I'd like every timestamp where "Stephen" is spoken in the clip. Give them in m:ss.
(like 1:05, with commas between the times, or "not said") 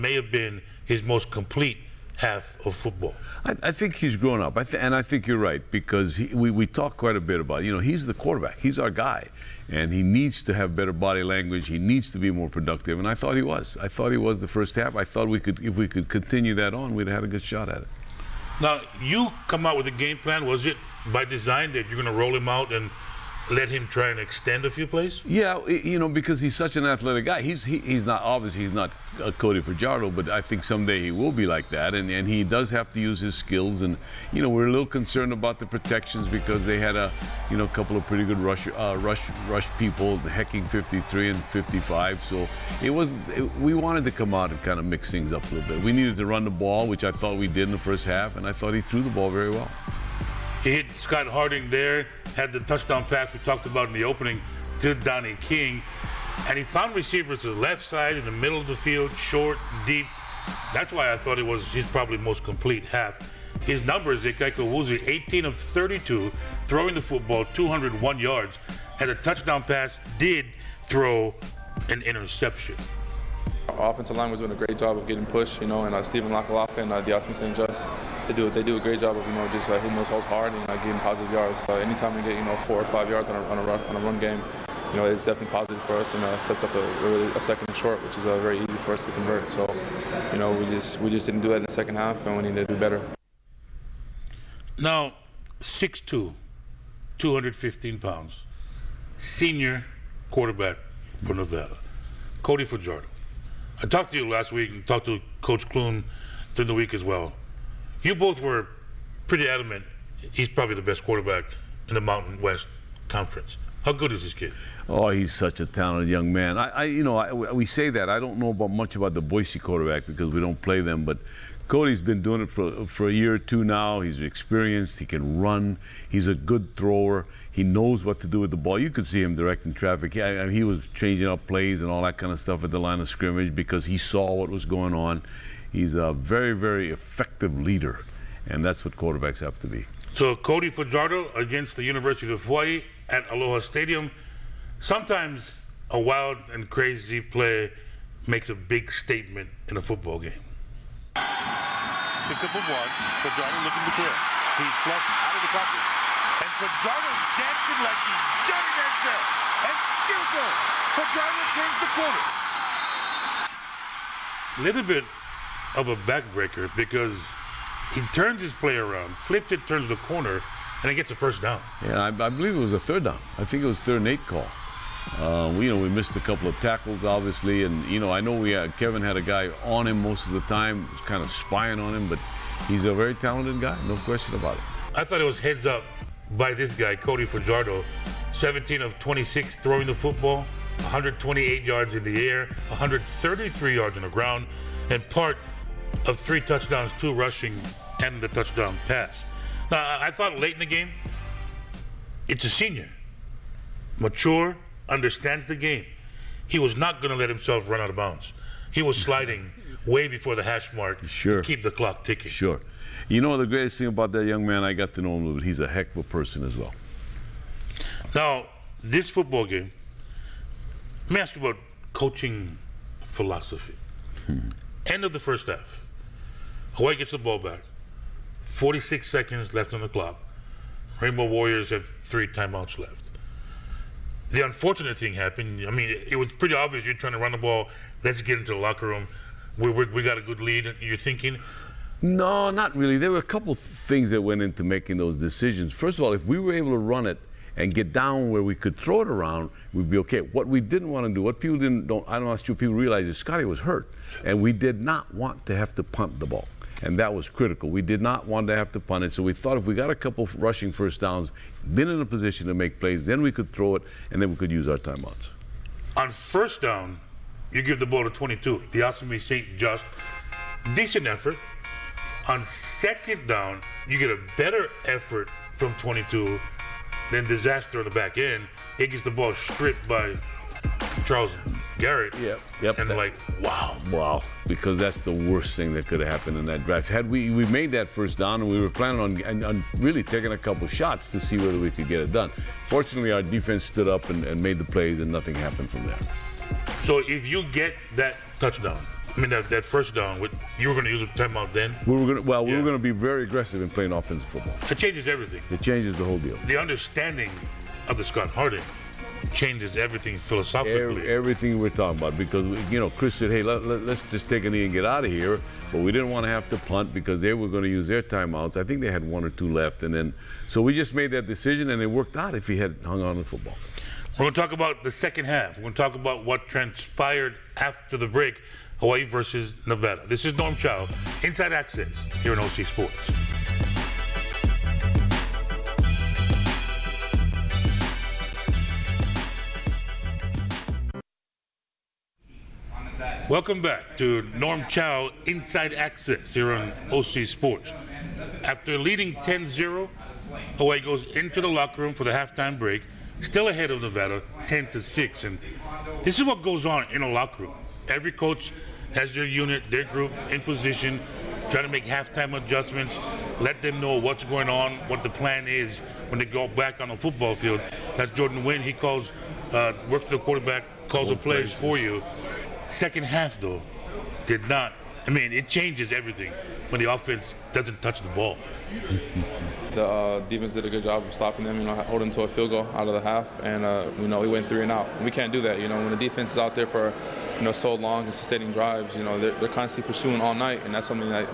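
1:16.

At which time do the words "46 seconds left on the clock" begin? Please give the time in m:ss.
3:48.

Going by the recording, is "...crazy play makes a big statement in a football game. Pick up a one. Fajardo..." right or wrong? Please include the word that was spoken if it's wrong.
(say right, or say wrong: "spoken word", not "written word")
right.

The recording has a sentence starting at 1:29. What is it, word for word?
So you know we just we just didn't do that in the second half, and we need to do better.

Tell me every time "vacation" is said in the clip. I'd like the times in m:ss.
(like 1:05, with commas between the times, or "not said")
not said.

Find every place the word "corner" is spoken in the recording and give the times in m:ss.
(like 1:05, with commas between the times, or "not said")
2:42, 2:50.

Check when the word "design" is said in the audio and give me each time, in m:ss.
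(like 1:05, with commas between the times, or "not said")
0:21.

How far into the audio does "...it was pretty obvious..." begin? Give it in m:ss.
3:56.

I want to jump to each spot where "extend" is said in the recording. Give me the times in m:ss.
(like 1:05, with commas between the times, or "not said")
0:24.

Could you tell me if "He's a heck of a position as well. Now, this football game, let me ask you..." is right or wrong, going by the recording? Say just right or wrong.
wrong.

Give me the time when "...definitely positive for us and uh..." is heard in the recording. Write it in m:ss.
1:25.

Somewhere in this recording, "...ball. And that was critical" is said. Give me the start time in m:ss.
4:16.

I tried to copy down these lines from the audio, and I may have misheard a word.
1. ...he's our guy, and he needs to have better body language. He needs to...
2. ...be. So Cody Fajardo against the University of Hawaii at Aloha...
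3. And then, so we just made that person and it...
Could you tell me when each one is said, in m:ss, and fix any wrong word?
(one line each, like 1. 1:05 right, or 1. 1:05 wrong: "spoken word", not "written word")
1. 0:08 right
2. 2:19 right
3. 5:19 wrong: "decision", not "person".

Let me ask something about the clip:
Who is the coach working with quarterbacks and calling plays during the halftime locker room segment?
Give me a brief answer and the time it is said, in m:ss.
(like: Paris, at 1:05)
Jordan Wynn, at 6:08.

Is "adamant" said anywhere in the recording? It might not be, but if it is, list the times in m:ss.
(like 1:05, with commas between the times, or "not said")
1:49.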